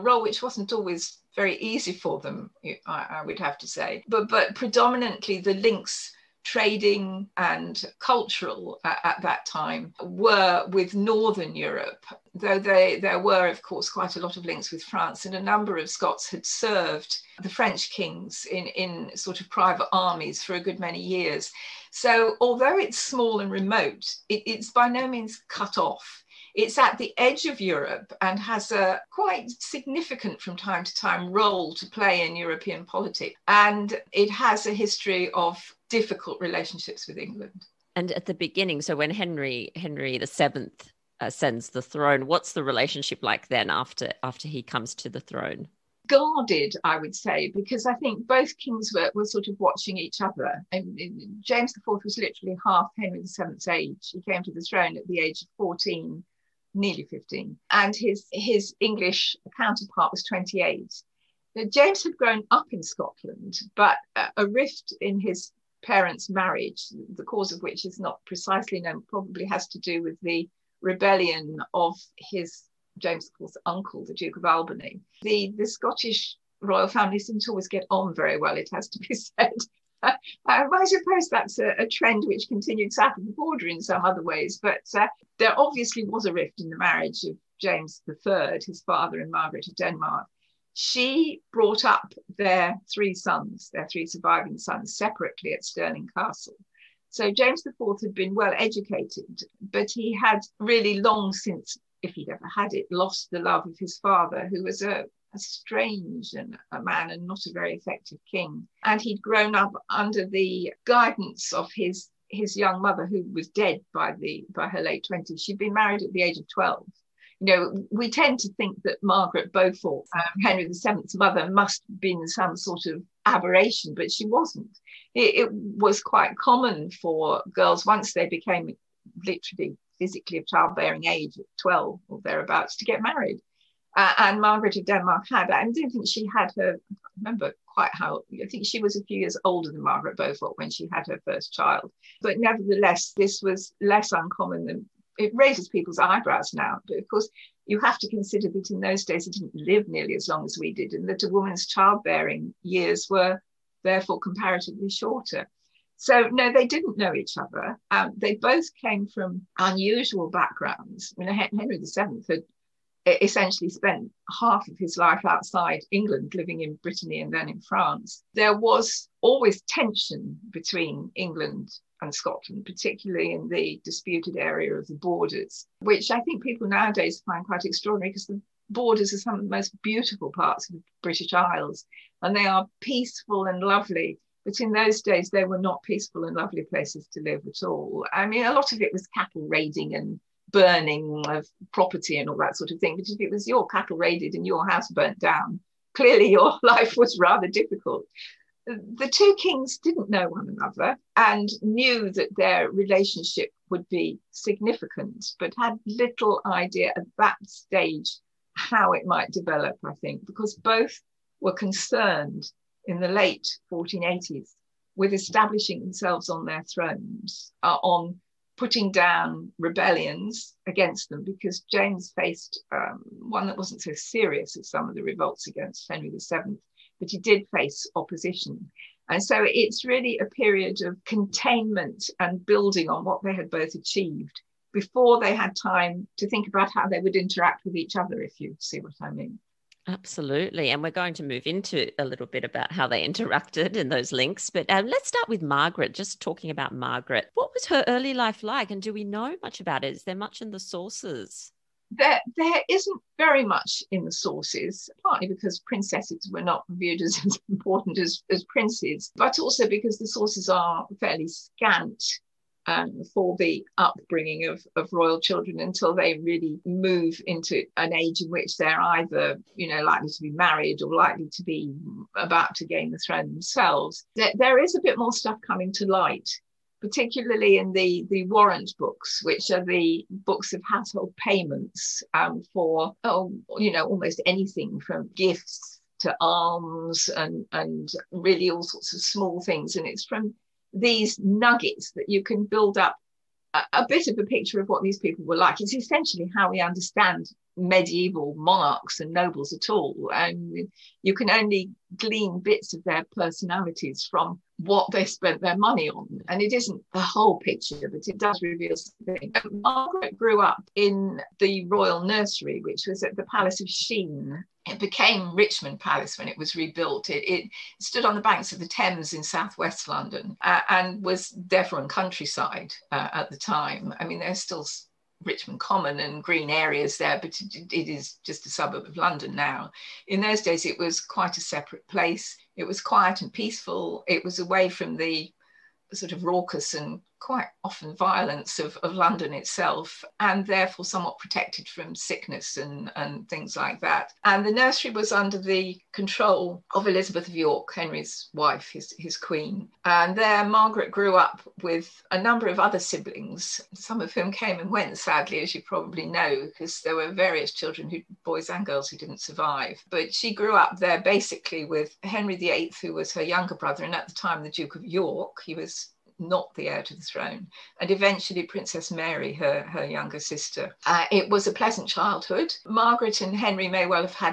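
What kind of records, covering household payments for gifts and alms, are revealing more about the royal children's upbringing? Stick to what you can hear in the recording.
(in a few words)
Warrant books.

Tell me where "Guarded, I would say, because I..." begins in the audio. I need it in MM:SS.
00:46.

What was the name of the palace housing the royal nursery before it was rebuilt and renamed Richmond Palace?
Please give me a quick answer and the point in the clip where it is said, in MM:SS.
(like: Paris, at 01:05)
Palace of Sheen, at 05:13.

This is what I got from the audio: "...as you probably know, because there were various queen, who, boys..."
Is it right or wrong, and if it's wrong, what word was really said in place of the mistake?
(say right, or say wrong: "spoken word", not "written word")
wrong: "children", not "queen".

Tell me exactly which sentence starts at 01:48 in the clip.
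And he'd grown up under the guidance of his his young mother, who was dead by the by her late twenties.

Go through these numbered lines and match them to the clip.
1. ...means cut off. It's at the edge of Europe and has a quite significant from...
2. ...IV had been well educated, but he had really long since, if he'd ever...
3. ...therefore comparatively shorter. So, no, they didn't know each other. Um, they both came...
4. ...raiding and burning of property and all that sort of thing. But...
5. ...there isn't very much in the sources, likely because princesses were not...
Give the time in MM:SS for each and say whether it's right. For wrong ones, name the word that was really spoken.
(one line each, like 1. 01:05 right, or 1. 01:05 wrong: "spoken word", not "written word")
1. 00:25 right
2. 01:37 right
3. 02:33 right
4. 03:09 right
5. 04:12 wrong: "partly", not "likely".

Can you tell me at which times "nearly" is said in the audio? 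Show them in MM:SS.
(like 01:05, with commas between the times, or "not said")
00:56, 02:29.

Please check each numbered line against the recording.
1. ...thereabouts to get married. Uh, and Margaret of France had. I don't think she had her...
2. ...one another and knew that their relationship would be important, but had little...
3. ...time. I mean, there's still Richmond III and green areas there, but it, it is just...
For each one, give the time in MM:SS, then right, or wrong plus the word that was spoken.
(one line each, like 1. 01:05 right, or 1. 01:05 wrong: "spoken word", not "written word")
1. 02:12 wrong: "Denmark", not "France"
2. 03:20 wrong: "significant", not "important"
3. 05:23 wrong: "Common", not "III".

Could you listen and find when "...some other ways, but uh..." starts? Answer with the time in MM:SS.
01:23.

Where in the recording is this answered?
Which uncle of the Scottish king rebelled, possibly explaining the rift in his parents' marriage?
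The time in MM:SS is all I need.
01:14.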